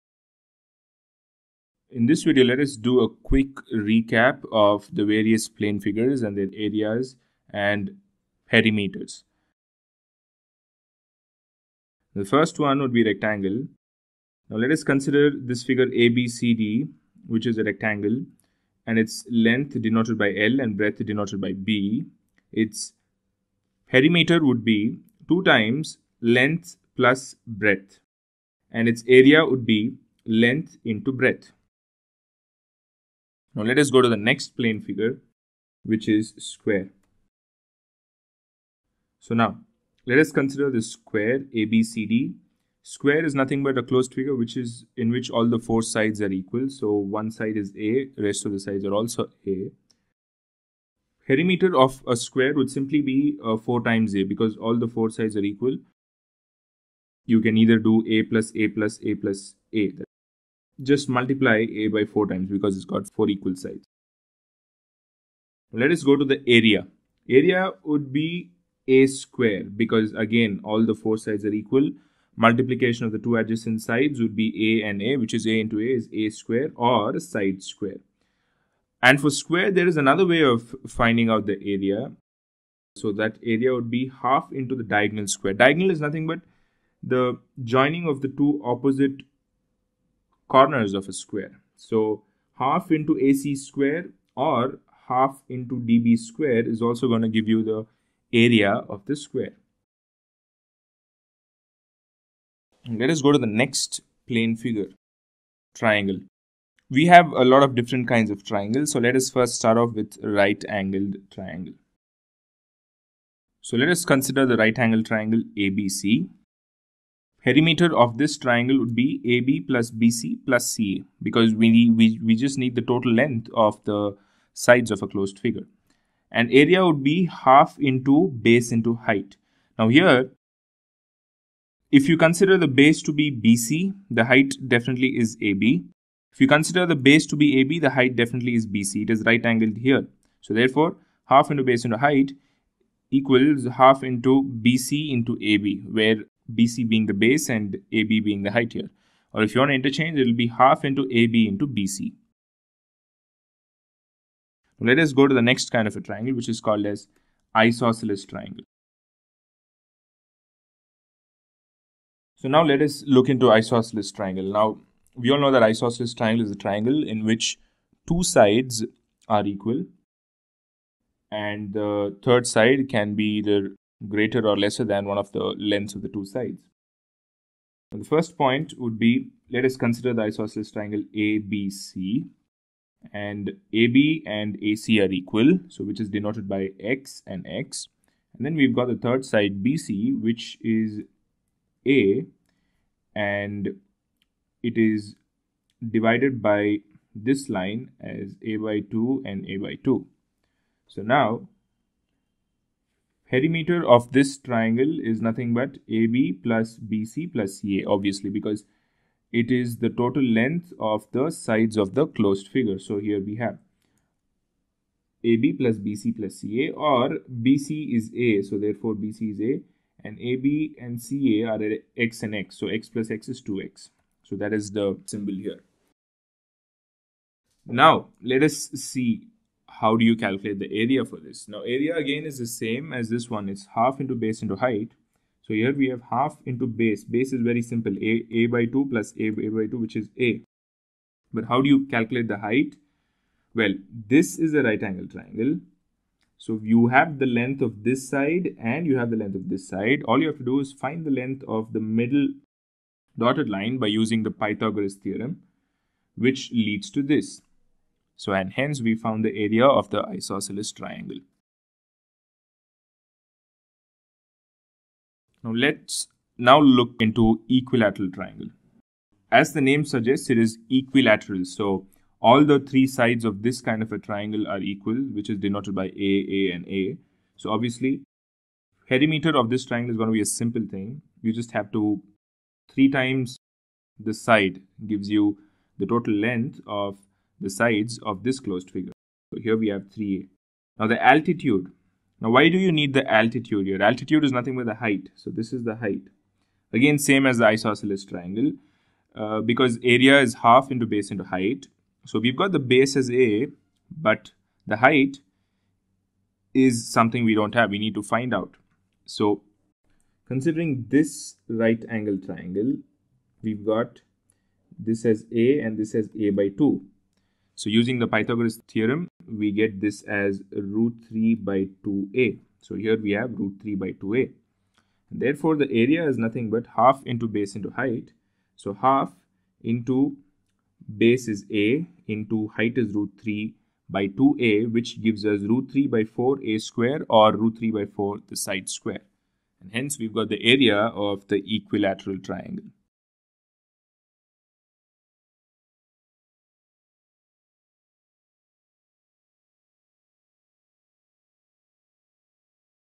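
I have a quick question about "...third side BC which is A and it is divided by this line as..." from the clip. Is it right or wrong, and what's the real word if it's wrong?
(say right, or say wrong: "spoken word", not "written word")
right.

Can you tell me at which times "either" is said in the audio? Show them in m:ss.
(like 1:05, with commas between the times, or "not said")
0:57, 2:53.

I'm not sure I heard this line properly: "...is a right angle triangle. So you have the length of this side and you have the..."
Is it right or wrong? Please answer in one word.
right.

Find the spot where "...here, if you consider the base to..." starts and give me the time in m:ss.
2:09.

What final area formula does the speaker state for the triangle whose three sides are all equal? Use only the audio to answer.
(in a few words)
root 3 by 4 a square.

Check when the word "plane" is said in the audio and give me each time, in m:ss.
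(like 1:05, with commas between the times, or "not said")
0:05, 0:34, 1:44.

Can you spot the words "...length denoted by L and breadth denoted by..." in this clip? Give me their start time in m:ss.
0:19.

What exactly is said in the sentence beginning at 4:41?
You just have to three times the side gives you the total length of the sides of this closed figure.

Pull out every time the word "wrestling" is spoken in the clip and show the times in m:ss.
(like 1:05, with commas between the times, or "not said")
not said.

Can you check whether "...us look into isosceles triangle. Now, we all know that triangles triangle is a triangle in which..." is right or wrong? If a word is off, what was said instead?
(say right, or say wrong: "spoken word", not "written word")
wrong: "isosceles", not "triangles".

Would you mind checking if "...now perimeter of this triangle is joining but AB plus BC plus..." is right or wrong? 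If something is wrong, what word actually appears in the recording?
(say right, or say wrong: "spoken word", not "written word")
wrong: "nothing", not "joining".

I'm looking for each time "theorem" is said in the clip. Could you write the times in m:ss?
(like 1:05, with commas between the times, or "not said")
4:14, 5:18.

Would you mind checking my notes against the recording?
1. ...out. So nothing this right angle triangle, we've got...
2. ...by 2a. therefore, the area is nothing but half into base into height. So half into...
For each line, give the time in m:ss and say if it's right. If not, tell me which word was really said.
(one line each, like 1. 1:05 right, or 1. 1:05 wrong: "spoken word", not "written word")
1. 5:08 wrong: "considering", not "nothing"
2. 5:23 right.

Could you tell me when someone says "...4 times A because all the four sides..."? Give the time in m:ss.
0:53.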